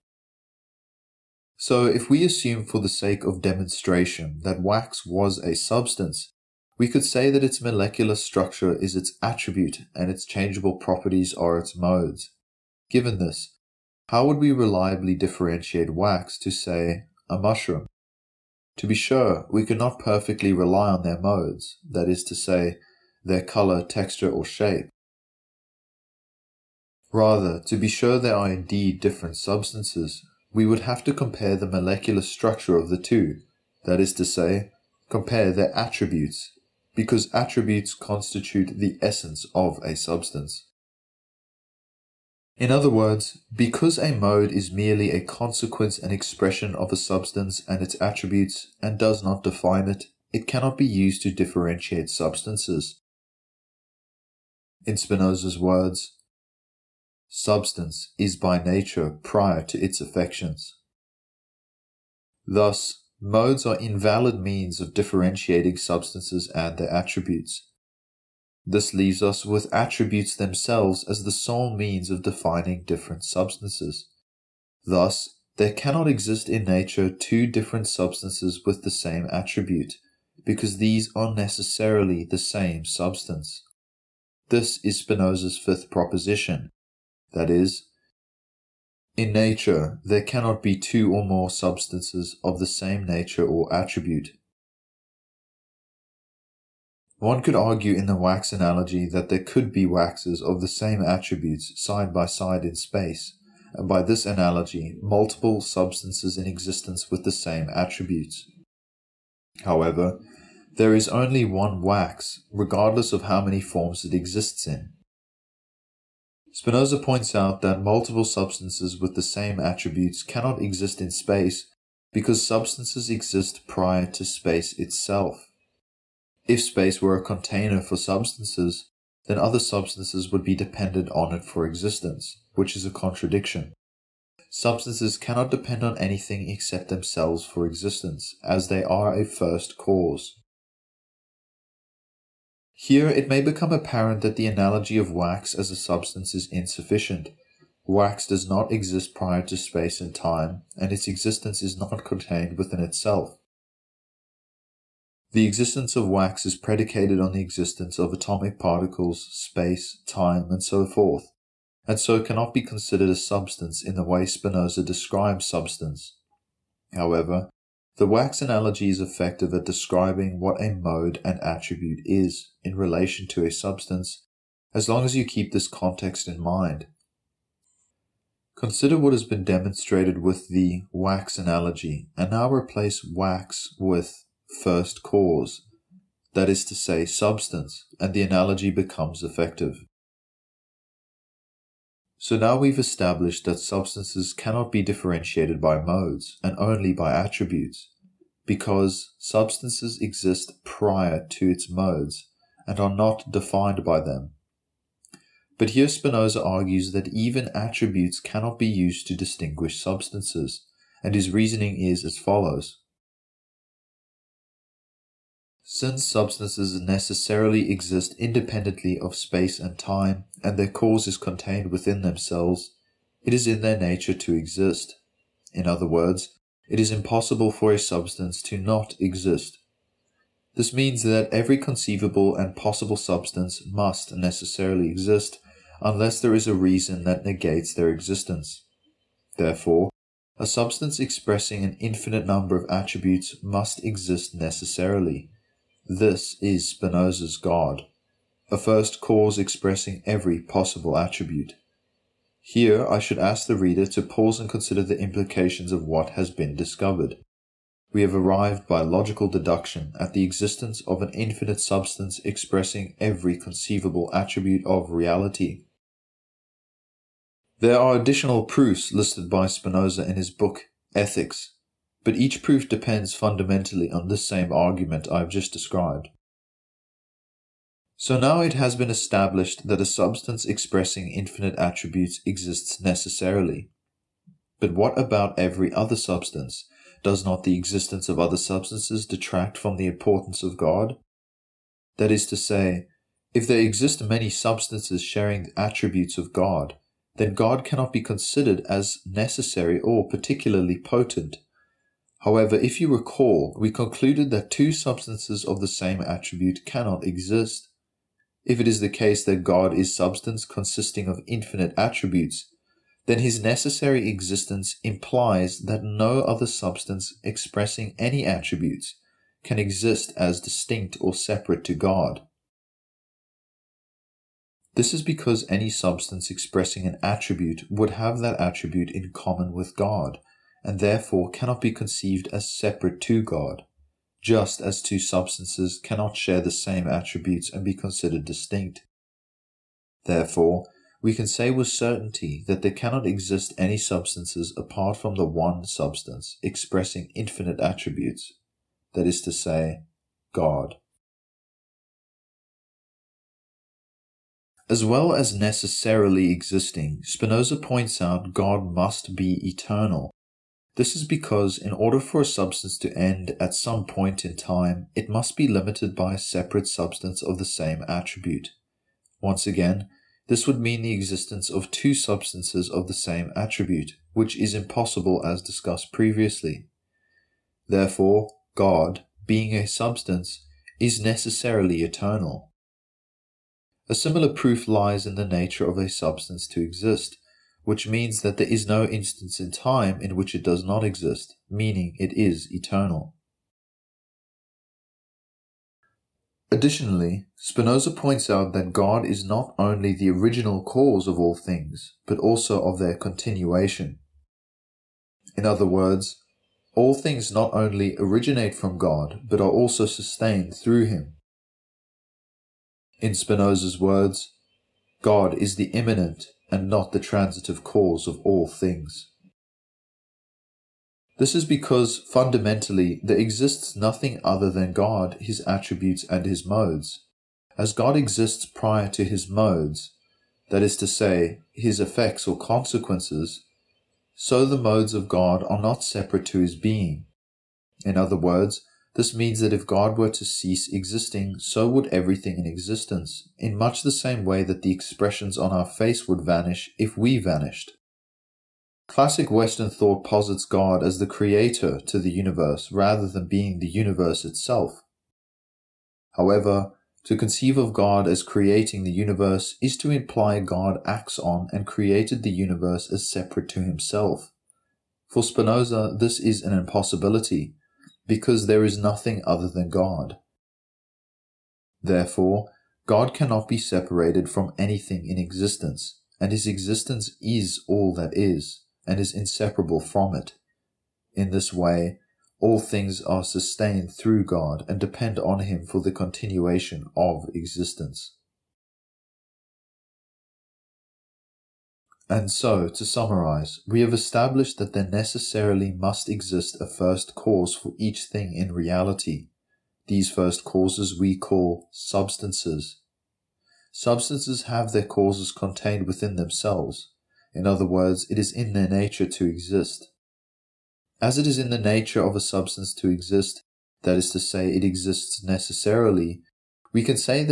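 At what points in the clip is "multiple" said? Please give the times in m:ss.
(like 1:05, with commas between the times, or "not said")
1:45, 1:57.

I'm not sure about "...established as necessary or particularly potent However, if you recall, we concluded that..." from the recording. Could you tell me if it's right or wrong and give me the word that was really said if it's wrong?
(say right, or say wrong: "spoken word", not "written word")
wrong: "considered", not "established".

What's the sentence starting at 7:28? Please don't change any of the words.
Classic Western thought posits God as the creator to the universe rather than being the universe itself.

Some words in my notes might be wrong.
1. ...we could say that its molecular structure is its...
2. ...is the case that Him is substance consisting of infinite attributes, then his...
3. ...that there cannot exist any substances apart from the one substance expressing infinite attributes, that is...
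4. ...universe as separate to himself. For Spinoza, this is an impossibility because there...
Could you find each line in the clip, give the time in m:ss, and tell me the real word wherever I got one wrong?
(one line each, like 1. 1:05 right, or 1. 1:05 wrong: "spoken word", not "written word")
1. 0:06 right
2. 5:08 wrong: "God", not "Him"
3. 5:42 right
4. 7:42 right.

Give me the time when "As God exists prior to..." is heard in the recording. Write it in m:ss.
7:07.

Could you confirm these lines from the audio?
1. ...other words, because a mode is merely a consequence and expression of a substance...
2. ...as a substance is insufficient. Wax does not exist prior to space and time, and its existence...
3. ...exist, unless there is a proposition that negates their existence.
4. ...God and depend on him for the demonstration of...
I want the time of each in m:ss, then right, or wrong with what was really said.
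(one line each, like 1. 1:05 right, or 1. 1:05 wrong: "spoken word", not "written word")
1. 0:42 right
2. 2:25 right
3. 3:54 wrong: "reason", not "proposition"
4. 8:04 wrong: "continuation", not "demonstration".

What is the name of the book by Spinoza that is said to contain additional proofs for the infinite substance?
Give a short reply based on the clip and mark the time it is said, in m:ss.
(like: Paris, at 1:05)
Ethics, at 4:30.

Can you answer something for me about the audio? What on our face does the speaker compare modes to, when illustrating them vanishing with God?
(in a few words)
Expressions.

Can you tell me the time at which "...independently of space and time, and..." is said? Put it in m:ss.
3:38.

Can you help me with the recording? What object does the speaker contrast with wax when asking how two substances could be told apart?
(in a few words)
A mushroom.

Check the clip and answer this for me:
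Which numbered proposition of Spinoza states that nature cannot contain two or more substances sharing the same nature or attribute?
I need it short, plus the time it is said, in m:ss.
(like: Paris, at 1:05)
Fifth, at 1:25.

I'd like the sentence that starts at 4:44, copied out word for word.
But what about every other substance?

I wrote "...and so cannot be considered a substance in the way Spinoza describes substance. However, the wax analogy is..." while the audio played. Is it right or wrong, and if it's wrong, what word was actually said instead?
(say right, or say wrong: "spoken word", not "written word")
right.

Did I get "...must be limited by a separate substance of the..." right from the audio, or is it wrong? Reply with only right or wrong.
right.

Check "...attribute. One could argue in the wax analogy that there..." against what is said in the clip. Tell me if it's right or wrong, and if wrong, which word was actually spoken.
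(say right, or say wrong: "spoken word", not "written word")
right.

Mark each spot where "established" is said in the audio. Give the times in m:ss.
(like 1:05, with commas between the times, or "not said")
3:12, 4:38, 8:13.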